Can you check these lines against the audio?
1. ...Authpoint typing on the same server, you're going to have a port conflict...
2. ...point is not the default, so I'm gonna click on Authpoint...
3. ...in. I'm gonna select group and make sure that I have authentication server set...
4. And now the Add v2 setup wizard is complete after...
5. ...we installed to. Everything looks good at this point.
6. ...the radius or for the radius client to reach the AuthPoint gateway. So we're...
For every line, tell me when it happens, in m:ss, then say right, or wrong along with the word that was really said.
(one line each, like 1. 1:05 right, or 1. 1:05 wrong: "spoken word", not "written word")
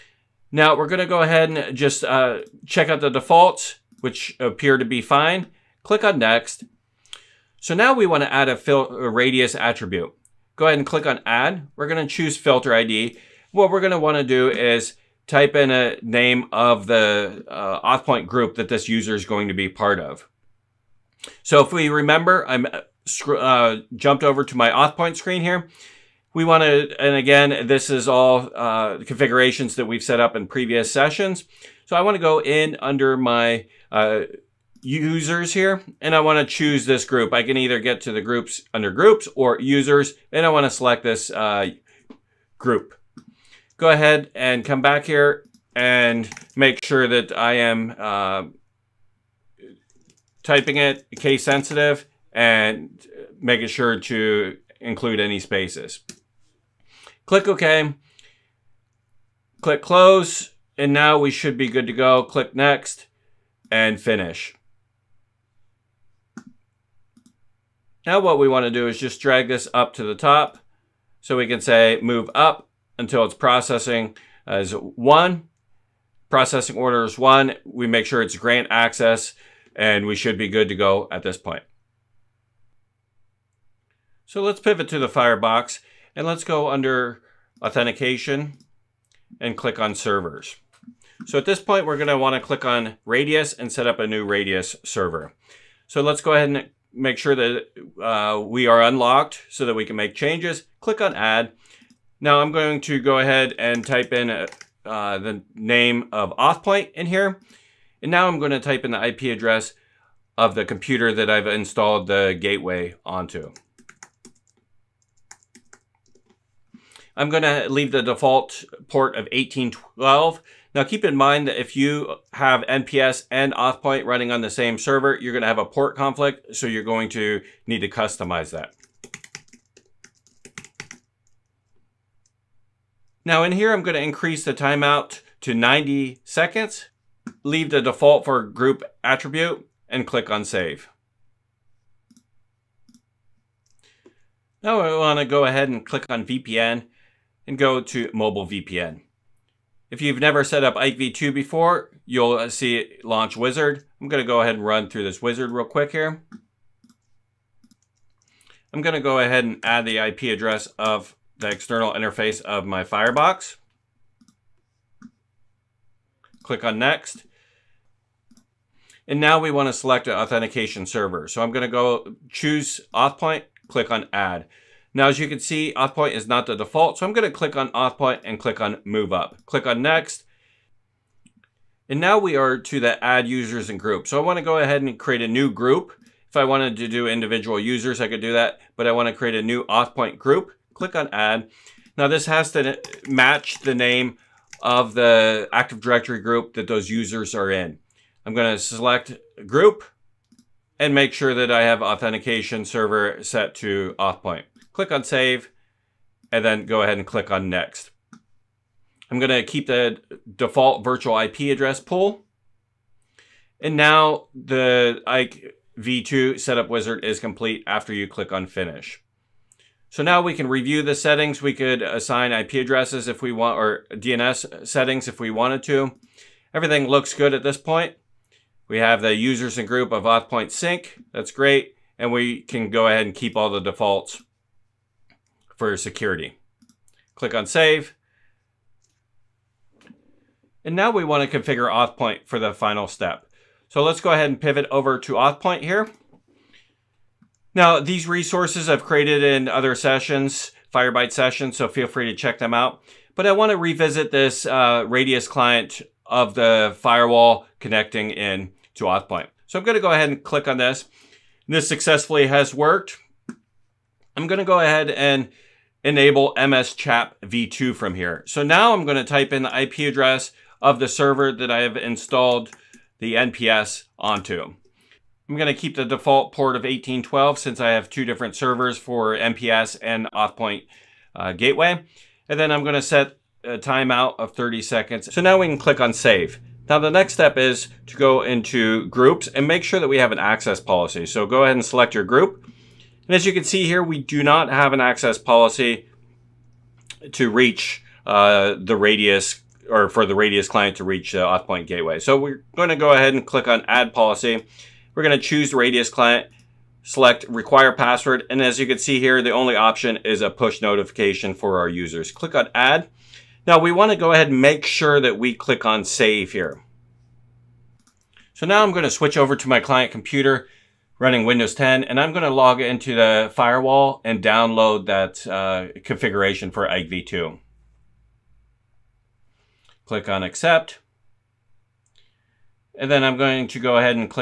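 1. 2:03 wrong: "running", not "typing"
2. 2:55 right
3. 3:17 right
4. 3:33 wrong: "Ike", not "Add"
5. 3:45 wrong: "wanted", not "installed"
6. 4:58 right.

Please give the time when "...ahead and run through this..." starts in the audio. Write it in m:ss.
2:34.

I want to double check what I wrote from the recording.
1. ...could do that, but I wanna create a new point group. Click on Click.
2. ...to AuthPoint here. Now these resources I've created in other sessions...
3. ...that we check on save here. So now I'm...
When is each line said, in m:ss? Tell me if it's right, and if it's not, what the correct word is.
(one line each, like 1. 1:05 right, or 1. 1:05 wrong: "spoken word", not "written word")
1. 3:08 wrong: "Add", not "Click"
2. 4:04 right
3. 5:14 wrong: "click", not "check".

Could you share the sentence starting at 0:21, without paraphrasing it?
So if we remember, I'm uh, uh jumped over to my AuthPoint screen here.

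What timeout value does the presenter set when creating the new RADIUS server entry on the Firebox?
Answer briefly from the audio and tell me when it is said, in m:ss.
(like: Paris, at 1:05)
90 seconds, at 2:15.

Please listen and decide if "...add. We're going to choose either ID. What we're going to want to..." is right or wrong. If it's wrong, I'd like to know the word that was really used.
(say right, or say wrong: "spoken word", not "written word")
wrong: "filter", not "either".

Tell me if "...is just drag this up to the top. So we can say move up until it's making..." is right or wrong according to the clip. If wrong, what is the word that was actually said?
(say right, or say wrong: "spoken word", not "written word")
wrong: "processing", not "making".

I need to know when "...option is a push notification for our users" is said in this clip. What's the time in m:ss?
5:09.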